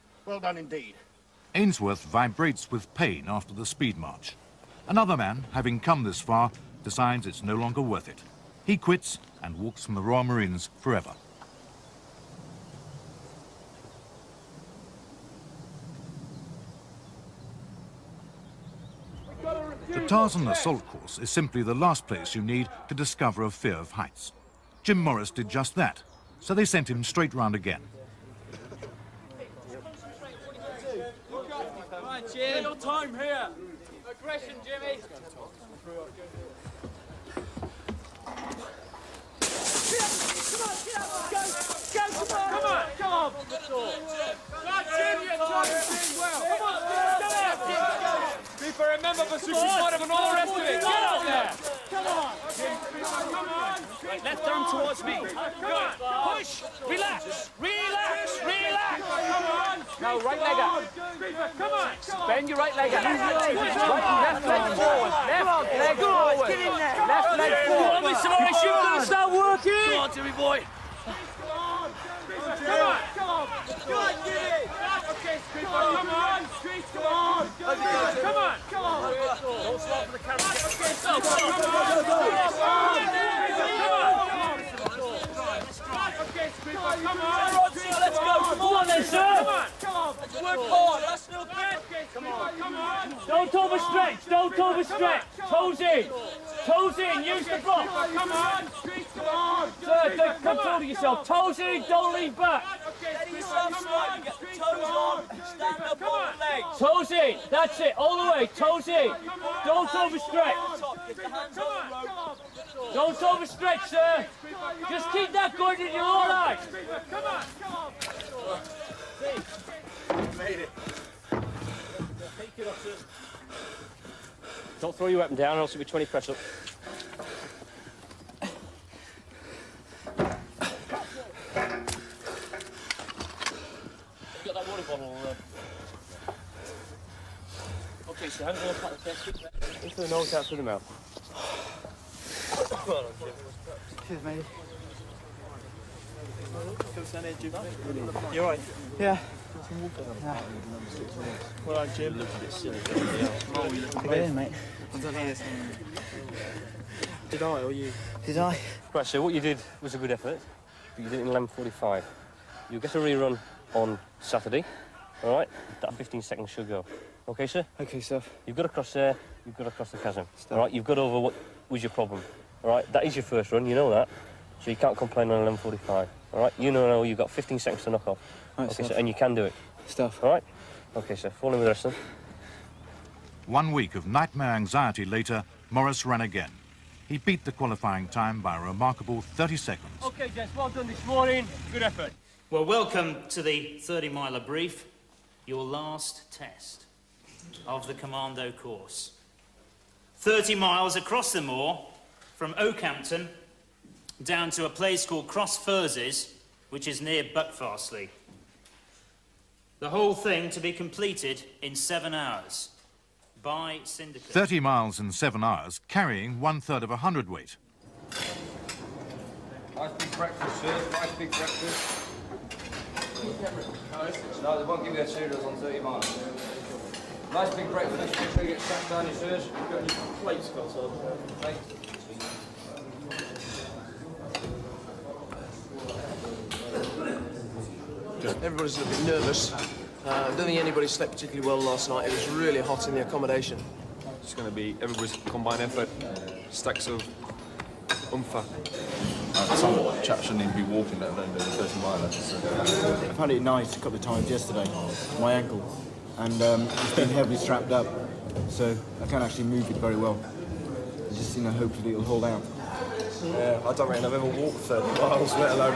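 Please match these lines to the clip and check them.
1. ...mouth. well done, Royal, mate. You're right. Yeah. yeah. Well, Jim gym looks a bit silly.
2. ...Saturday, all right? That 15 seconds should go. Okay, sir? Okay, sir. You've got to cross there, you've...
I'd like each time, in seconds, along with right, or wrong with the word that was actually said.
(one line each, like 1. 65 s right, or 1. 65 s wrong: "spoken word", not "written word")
1. 140 s wrong: "Cheers", not "Royal"
2. 164 s right.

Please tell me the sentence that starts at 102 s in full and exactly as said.
toes stand up on the in, that's it, all the way, toes in.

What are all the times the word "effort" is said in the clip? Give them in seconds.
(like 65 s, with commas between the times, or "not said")
160 s, 191 s, 245 s.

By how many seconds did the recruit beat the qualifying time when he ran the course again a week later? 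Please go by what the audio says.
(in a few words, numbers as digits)
30 seconds.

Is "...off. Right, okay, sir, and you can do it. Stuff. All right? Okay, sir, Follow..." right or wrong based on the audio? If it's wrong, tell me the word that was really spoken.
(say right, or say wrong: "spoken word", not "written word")
right.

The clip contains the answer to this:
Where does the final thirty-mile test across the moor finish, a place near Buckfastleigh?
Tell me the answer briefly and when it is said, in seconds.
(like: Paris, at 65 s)
Cross Furzes, at 205 s.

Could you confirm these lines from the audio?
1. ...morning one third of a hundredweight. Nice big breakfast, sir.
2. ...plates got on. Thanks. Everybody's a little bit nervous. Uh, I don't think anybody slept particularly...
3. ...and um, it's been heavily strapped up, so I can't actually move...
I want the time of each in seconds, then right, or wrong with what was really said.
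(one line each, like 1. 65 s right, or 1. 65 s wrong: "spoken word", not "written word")
1. 215 s wrong: "carrying", not "morning"
2. 230 s right
3. 256 s right.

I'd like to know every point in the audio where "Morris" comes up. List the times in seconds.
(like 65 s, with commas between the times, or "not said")
24 s, 68 s, 185 s.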